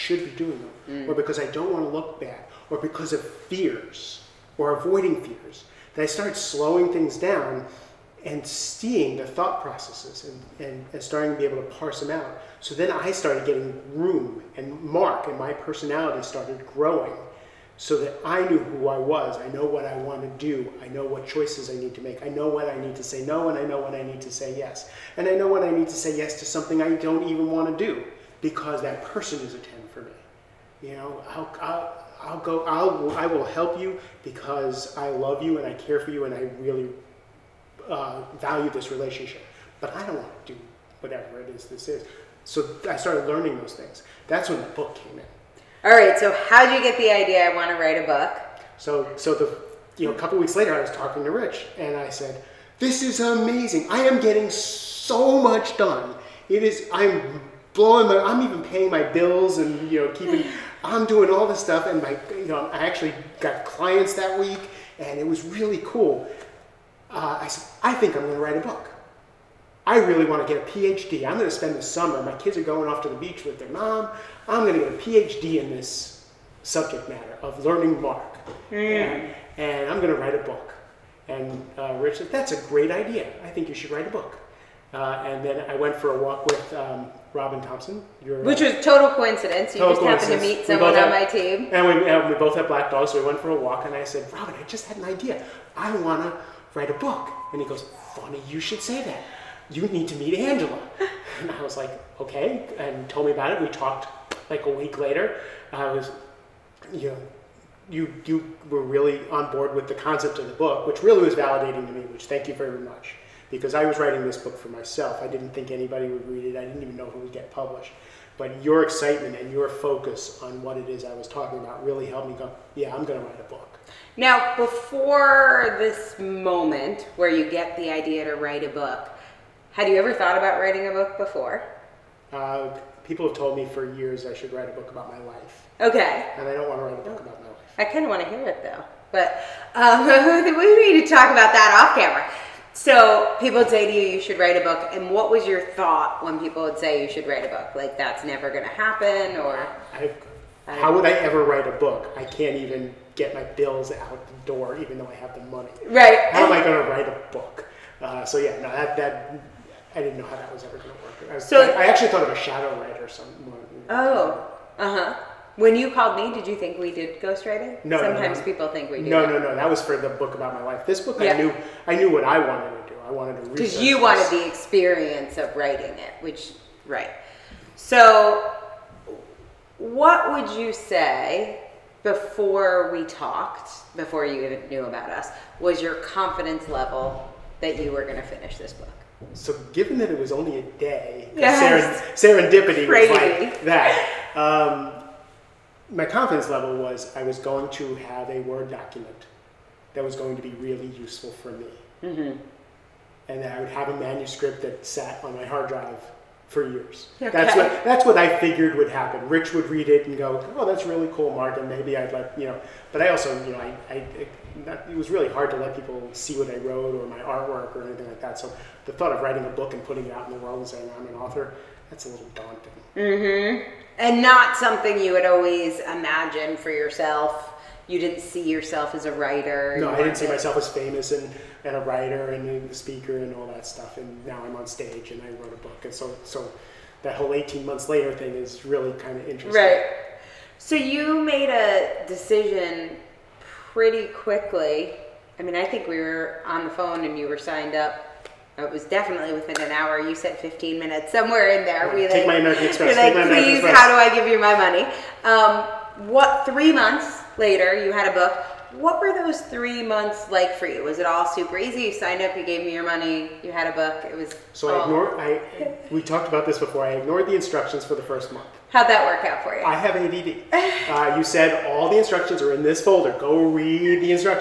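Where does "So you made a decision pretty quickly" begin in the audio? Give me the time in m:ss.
4:00.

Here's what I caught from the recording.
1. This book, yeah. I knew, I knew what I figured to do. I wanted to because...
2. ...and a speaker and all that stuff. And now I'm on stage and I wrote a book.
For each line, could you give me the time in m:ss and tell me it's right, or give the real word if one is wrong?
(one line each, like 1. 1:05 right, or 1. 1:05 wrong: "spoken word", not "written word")
1. 2:50 wrong: "wanted", not "figured"
2. 3:52 right.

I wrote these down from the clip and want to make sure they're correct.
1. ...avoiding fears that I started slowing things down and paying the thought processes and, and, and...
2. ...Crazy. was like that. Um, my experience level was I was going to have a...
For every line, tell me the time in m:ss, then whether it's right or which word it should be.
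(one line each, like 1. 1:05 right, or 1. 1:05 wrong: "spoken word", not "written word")
1. 0:04 wrong: "seeing", not "paying"
2. 3:12 wrong: "confidence", not "experience".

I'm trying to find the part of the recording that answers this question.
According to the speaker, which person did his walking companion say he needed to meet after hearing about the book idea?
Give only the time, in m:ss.
1:40.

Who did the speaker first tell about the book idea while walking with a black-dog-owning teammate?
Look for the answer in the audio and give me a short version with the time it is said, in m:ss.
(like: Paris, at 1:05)
Robin Thompson, at 1:27.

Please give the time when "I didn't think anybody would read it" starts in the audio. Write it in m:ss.
1:55.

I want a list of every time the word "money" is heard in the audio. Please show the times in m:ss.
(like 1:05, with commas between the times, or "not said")
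2:35, 4:14, 4:22.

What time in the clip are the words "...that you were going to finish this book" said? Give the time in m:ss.
3:07.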